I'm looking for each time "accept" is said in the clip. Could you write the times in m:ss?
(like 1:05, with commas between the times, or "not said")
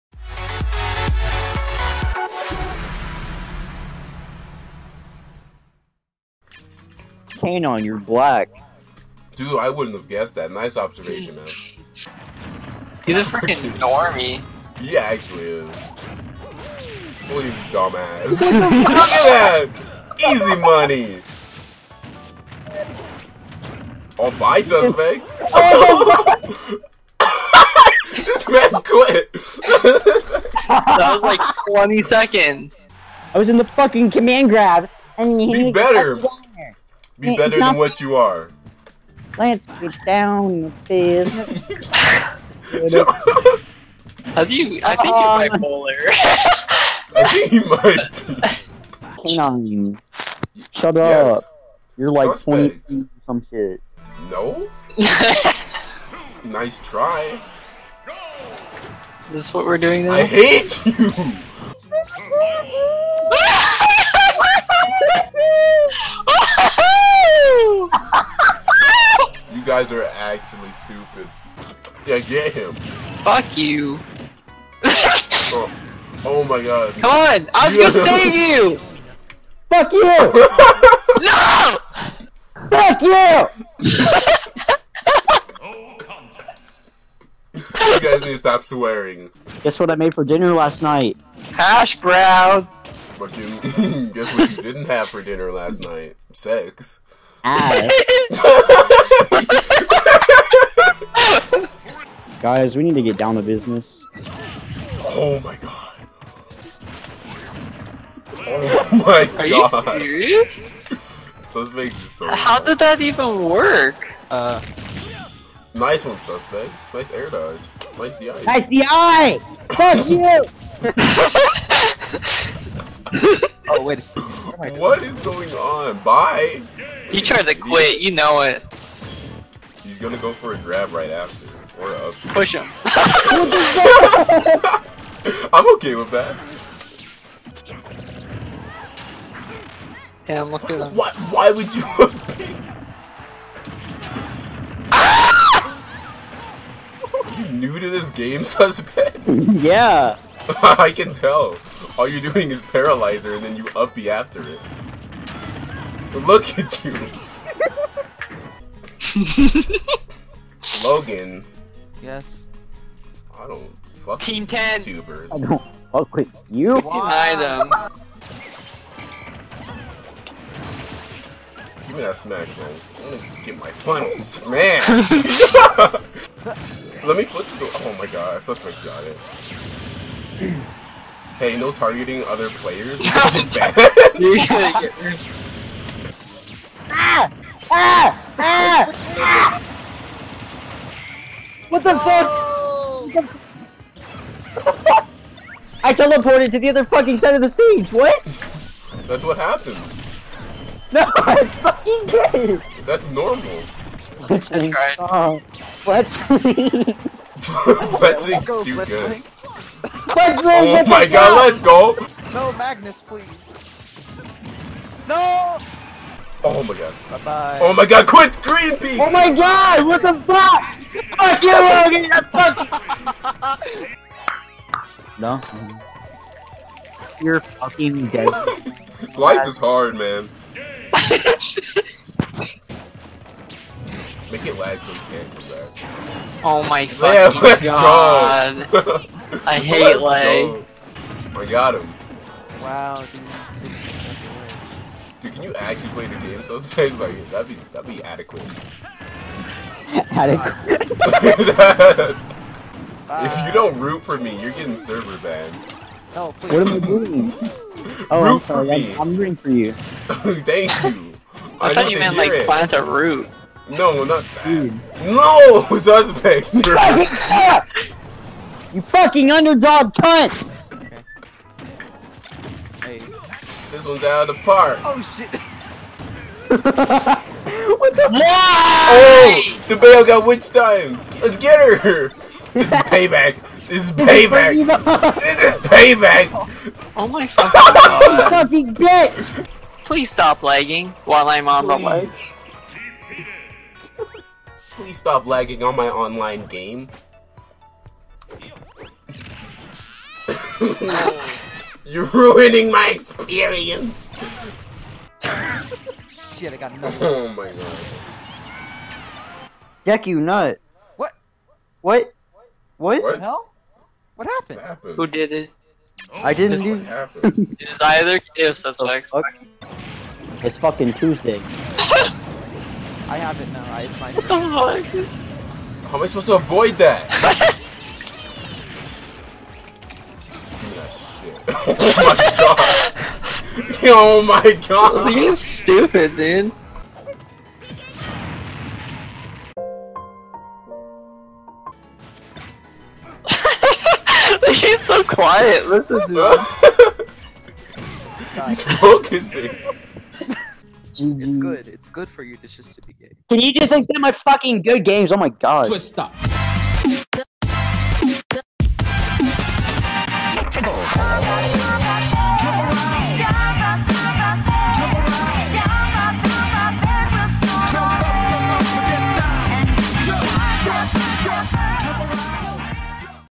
5:53.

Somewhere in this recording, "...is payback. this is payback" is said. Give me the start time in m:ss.
4:43.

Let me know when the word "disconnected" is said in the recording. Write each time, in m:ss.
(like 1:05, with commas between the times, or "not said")
not said.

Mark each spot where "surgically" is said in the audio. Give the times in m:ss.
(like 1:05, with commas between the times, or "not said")
not said.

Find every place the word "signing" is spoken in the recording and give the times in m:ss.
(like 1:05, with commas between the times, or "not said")
not said.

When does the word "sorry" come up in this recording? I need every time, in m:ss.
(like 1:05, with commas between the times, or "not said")
4:18.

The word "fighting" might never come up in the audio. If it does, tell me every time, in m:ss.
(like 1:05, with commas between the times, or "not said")
not said.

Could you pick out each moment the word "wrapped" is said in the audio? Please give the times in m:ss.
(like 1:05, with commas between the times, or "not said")
not said.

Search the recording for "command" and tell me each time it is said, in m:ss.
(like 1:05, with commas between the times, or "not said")
0:34.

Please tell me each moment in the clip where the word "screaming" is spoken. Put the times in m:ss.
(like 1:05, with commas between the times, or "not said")
3:38.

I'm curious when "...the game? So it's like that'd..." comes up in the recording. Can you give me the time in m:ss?
4:06.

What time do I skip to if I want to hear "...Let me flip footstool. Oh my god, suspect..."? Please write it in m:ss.
2:57.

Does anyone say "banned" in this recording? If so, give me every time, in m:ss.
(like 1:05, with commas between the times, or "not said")
4:15.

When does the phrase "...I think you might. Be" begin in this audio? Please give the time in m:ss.
0:47.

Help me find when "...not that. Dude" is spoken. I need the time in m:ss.
4:24.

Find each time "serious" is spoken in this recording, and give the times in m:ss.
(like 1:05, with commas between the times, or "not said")
1:49.